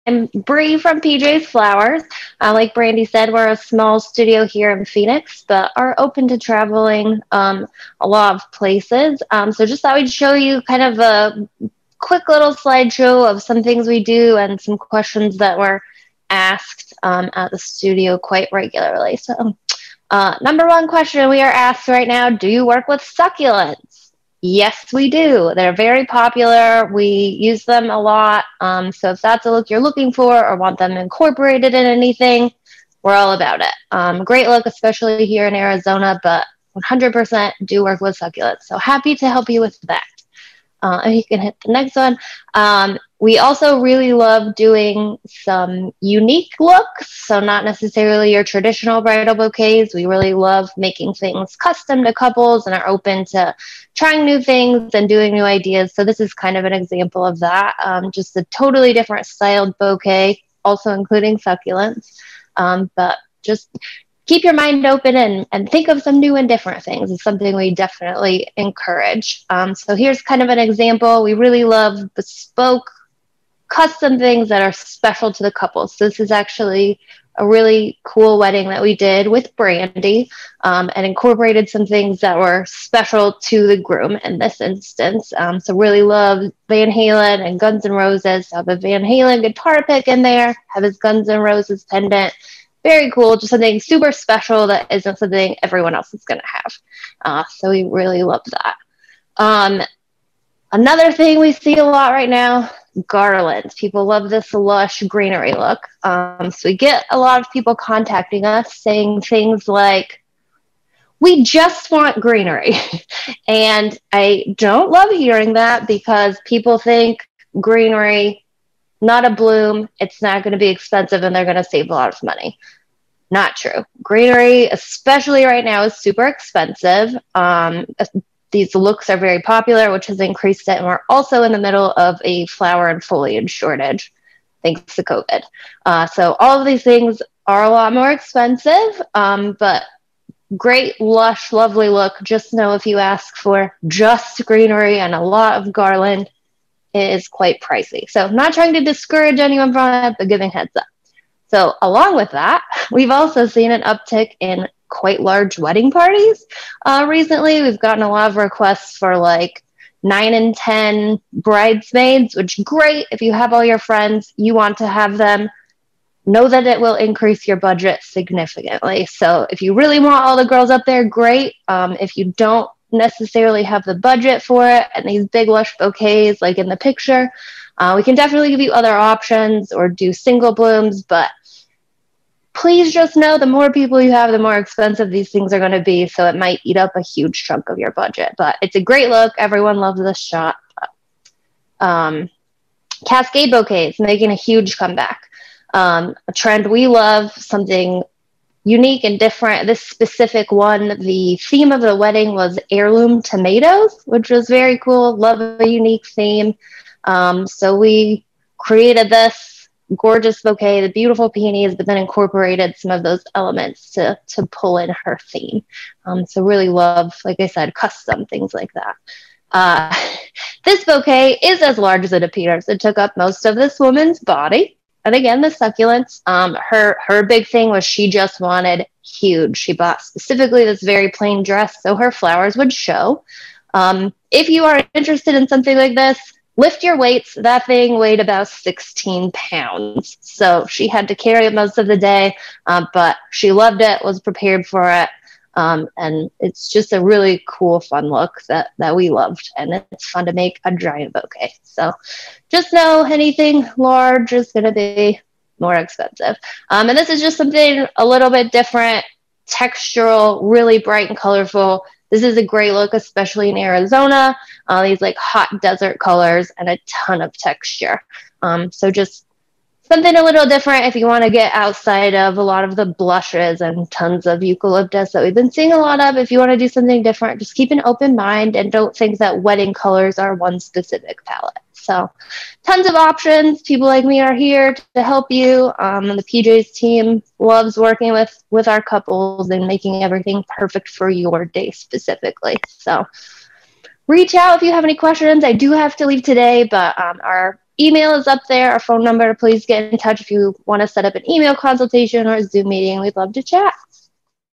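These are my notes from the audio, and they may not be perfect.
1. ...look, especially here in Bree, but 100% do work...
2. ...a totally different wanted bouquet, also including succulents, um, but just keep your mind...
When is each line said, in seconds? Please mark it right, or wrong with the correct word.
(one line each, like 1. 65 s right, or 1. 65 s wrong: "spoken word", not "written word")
1. 34 s wrong: "Arizona", not "Bree"
2. 58 s wrong: "styled", not "wanted".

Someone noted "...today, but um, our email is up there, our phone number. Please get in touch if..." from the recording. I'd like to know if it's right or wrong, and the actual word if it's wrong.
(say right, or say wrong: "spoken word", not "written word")
right.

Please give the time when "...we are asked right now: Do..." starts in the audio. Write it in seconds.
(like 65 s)
21 s.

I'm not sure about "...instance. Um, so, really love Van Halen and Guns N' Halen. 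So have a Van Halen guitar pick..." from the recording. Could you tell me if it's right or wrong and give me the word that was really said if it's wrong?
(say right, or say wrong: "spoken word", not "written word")
wrong: "Roses", not "Halen".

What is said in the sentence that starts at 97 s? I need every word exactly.
Uh, so we really love that.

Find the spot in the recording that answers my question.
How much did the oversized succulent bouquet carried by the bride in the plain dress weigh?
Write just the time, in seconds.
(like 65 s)
238 s.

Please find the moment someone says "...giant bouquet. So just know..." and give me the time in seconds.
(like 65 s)
250 s.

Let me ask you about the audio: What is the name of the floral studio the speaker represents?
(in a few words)
PJ's Flowers.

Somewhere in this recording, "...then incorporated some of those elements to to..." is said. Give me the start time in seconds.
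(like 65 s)
211 s.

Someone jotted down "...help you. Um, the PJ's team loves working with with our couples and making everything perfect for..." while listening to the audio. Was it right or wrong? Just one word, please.
right.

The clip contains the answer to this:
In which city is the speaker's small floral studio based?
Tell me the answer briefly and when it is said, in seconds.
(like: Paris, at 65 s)
Phoenix, at 4 s.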